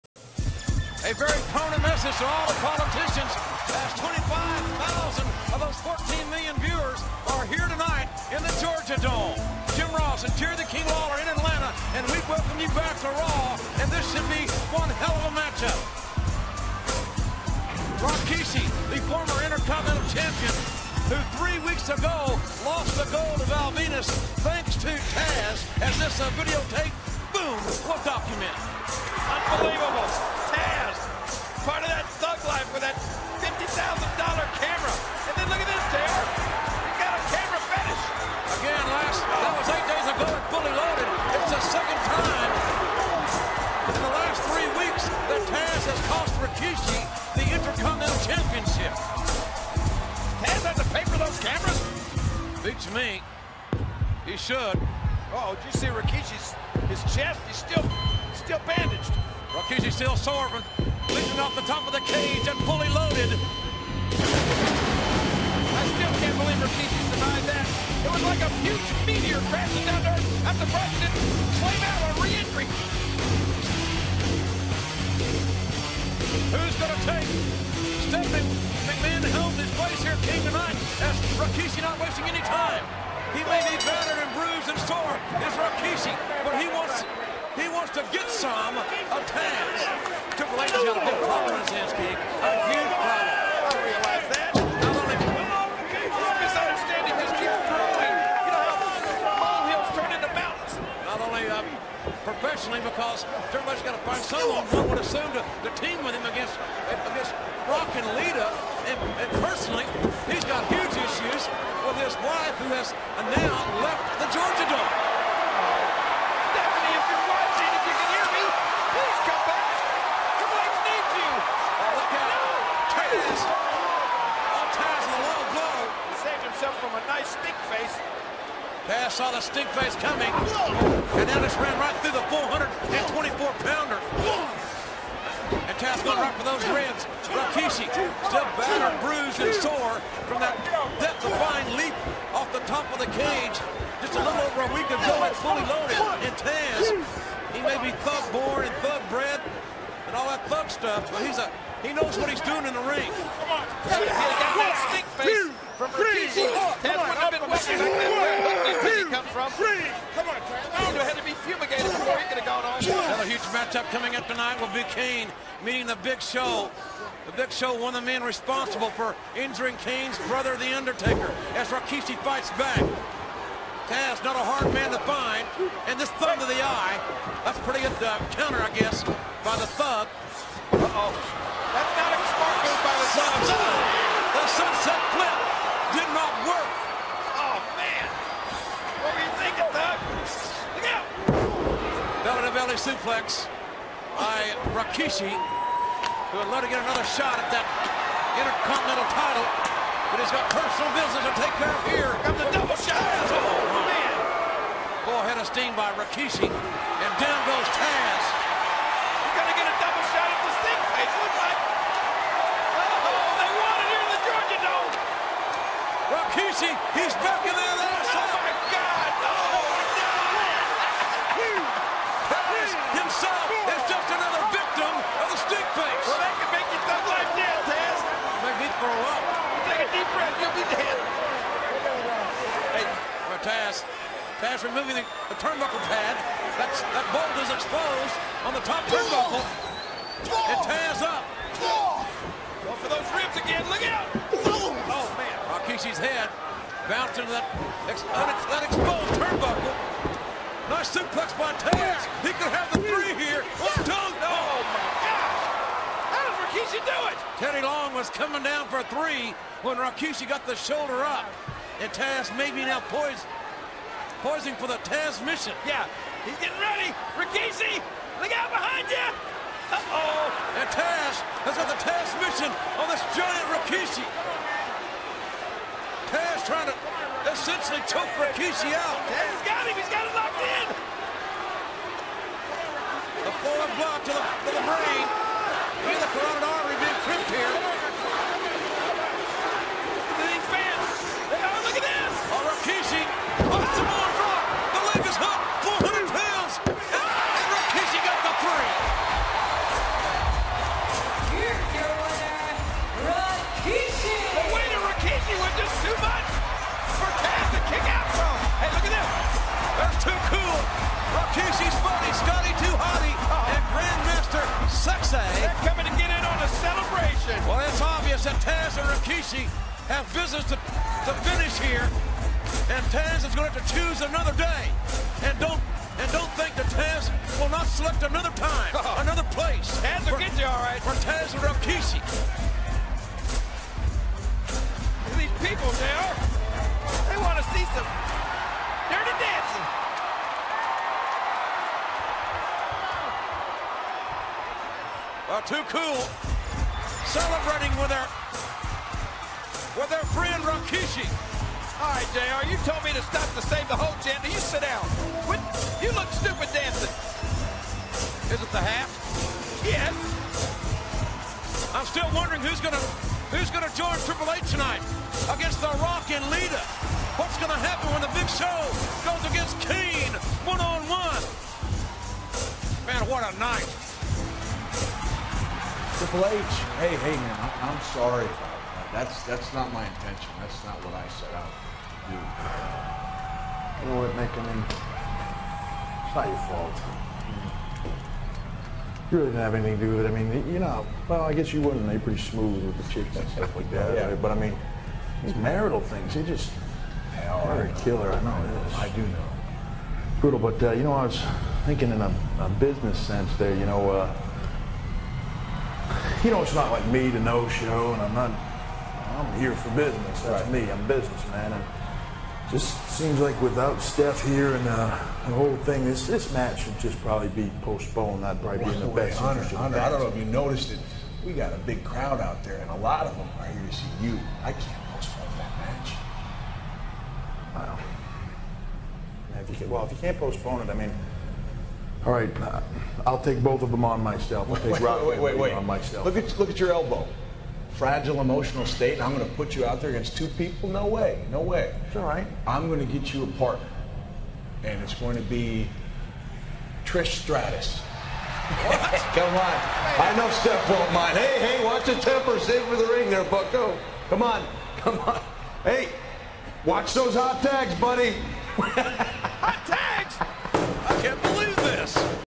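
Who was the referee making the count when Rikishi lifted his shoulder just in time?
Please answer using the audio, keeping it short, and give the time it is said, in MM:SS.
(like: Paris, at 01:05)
Teddy Long, at 04:17.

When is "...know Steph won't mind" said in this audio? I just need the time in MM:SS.
07:30.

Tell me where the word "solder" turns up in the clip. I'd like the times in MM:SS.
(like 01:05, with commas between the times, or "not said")
not said.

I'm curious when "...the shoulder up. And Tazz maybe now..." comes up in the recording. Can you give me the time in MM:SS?
04:20.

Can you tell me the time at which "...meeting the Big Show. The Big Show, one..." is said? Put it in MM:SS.
02:45.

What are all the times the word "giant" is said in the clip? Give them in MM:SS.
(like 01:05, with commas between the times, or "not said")
04:33.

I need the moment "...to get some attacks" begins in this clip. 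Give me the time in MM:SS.
01:27.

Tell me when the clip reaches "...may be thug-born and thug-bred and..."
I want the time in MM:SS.
02:27.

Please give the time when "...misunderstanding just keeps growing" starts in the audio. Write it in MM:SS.
01:36.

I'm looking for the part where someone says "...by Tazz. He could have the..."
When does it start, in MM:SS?
04:11.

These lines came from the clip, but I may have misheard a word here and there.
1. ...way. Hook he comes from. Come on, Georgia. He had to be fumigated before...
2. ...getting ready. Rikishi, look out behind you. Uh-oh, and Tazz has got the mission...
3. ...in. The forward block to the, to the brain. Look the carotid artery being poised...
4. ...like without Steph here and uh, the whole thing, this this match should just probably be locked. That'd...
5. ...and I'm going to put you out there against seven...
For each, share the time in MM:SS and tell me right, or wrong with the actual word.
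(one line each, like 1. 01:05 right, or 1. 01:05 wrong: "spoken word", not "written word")
1. 02:38 wrong: "Tazz", not "Georgia"
2. 04:26 right
3. 04:40 wrong: "crimped", not "poised"
4. 06:53 wrong: "postponed", not "locked"
5. 07:18 wrong: "two", not "seven".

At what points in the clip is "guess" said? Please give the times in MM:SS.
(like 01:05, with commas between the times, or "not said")
02:58, 06:31.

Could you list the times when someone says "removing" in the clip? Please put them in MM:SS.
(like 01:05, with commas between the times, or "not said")
03:54.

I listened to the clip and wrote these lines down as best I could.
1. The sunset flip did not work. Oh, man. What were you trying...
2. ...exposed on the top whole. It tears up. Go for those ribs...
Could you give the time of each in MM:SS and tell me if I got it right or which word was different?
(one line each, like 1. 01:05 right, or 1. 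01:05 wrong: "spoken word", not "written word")
1. 03:04 wrong: "thinking", not "trying"
2. 03:57 wrong: "turnbuckle", not "whole".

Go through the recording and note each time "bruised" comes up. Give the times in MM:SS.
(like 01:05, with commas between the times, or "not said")
01:24, 02:18.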